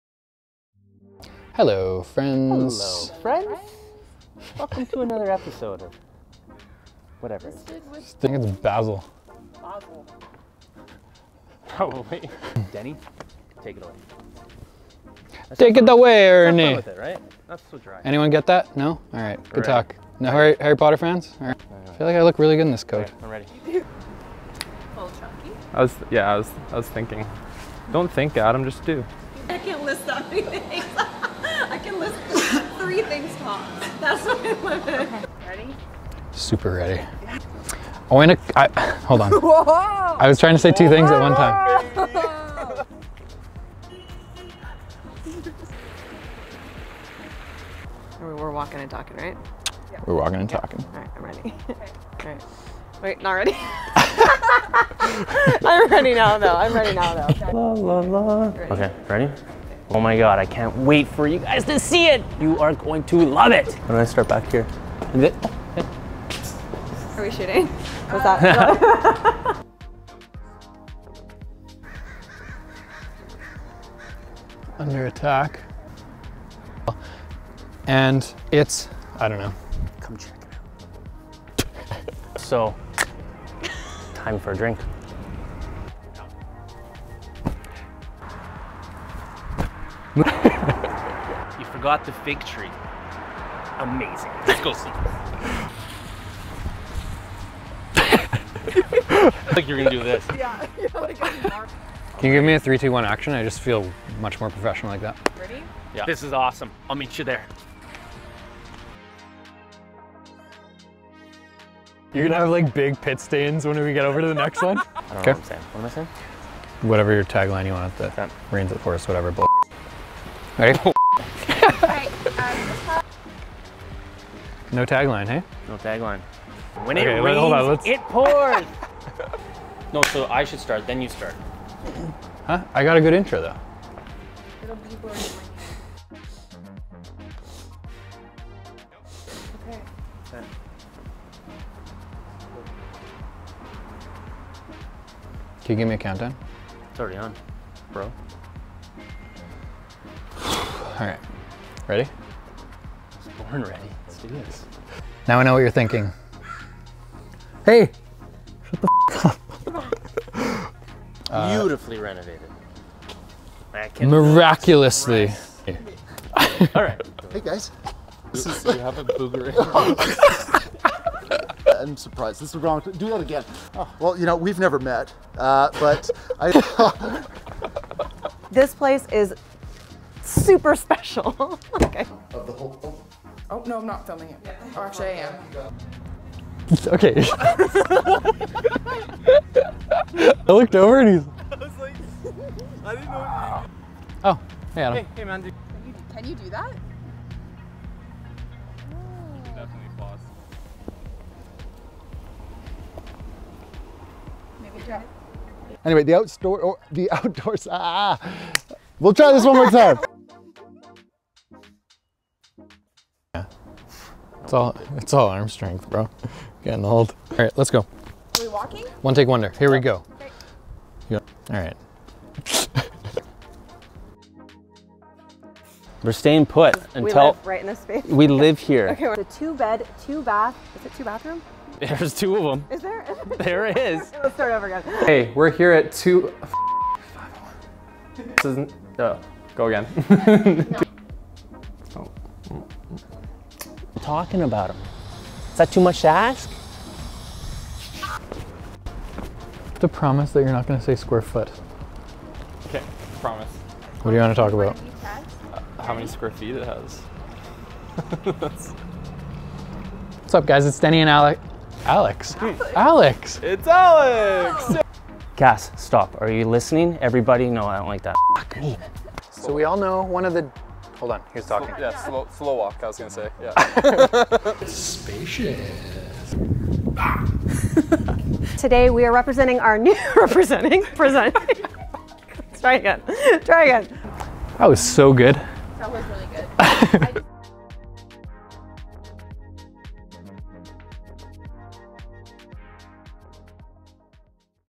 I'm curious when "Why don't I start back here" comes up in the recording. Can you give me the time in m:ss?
1:03.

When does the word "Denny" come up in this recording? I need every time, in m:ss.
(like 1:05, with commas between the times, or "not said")
0:12, 4:20.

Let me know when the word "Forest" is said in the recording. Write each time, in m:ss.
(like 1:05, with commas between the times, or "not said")
1:58.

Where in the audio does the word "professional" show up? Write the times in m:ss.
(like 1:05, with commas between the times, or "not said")
1:44.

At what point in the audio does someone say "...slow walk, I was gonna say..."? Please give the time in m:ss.
4:32.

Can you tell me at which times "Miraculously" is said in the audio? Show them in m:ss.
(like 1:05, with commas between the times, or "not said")
2:44.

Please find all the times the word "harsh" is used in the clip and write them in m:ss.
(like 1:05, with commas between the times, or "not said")
not said.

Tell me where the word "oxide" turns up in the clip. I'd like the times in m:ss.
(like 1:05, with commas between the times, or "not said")
not said.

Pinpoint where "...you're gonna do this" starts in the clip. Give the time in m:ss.
1:39.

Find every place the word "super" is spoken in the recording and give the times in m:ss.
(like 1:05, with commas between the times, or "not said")
0:36, 3:00.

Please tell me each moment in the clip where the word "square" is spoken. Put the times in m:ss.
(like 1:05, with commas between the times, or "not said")
4:10, 4:16.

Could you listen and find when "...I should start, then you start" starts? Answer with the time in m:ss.
2:10.